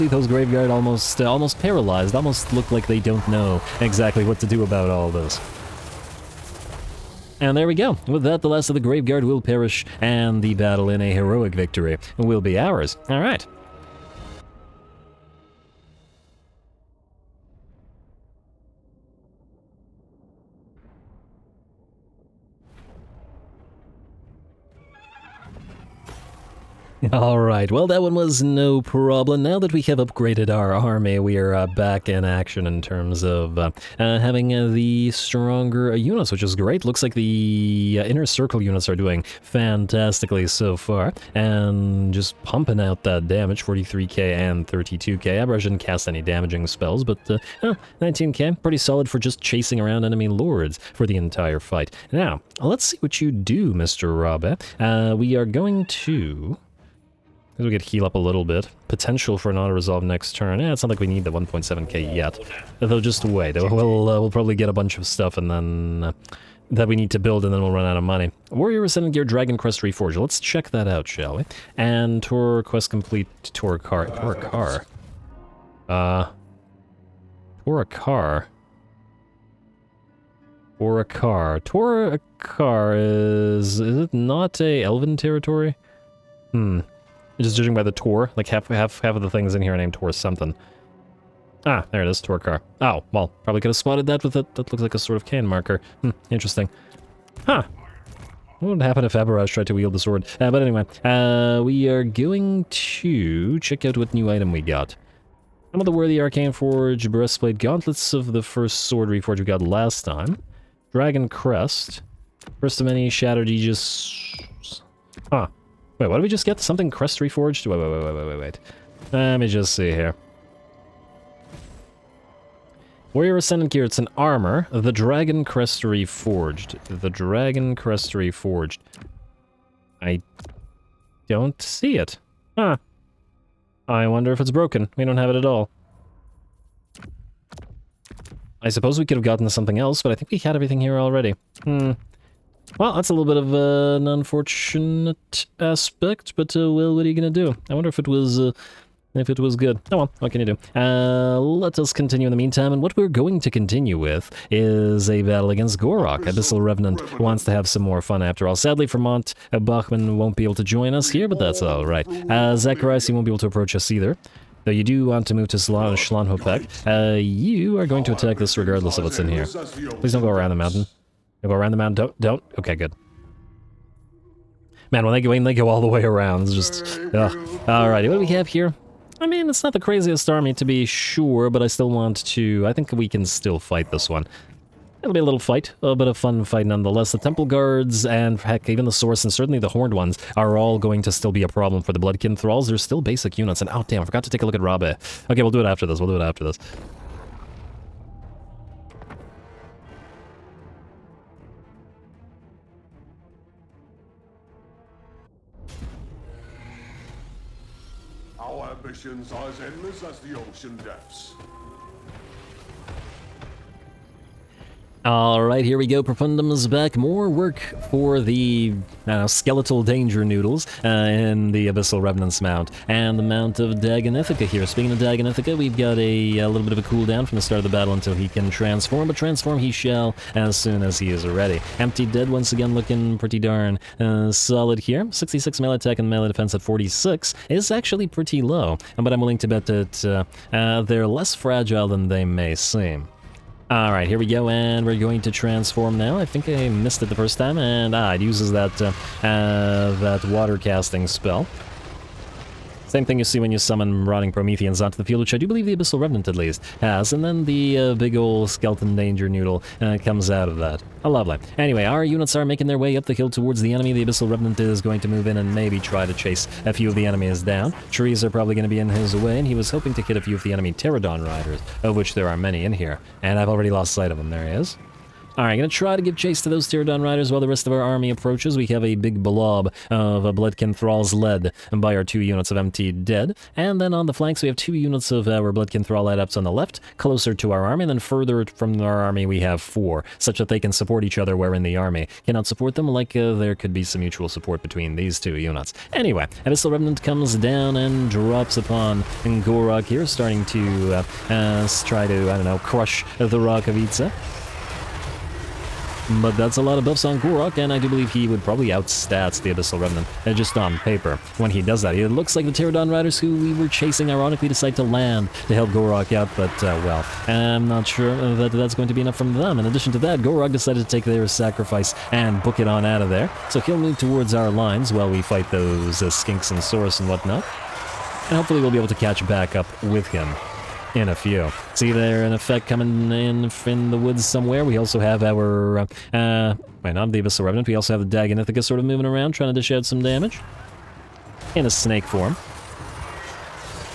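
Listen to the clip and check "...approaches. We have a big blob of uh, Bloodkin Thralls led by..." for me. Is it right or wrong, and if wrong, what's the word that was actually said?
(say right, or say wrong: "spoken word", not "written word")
right.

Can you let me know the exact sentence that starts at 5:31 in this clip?
See there an effect coming in in the woods somewhere.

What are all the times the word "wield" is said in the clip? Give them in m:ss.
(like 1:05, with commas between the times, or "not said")
1:39.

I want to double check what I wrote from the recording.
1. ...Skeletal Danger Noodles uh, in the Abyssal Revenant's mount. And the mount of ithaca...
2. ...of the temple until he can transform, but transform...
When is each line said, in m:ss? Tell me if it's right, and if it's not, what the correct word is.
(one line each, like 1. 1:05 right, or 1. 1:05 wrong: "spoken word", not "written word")
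1. 3:39 right
2. 3:47 wrong: "battle", not "temple".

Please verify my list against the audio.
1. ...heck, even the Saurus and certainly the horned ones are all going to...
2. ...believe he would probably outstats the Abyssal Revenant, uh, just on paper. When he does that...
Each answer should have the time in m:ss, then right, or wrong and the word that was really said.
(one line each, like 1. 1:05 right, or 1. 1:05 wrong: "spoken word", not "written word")
1. 3:08 right
2. 5:07 right.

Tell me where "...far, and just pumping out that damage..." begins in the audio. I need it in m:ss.
0:40.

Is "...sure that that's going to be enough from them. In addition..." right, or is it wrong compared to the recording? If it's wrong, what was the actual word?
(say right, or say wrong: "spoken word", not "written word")
right.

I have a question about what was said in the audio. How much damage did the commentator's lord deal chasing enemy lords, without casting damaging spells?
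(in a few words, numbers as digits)
19k.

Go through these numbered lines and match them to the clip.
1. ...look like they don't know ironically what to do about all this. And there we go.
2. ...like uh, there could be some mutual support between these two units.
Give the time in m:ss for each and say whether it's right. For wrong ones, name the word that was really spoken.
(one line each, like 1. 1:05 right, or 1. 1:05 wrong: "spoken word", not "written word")
1. 0:02 wrong: "exactly", not "ironically"
2. 4:52 right.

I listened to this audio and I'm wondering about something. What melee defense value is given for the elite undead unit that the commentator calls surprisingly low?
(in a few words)
46.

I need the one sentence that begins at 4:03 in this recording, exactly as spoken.
Alright, here we go, and we're going to transform now.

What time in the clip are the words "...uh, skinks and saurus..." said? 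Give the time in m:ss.
5:26.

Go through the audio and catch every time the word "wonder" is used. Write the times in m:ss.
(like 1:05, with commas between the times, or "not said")
2:14, 2:27.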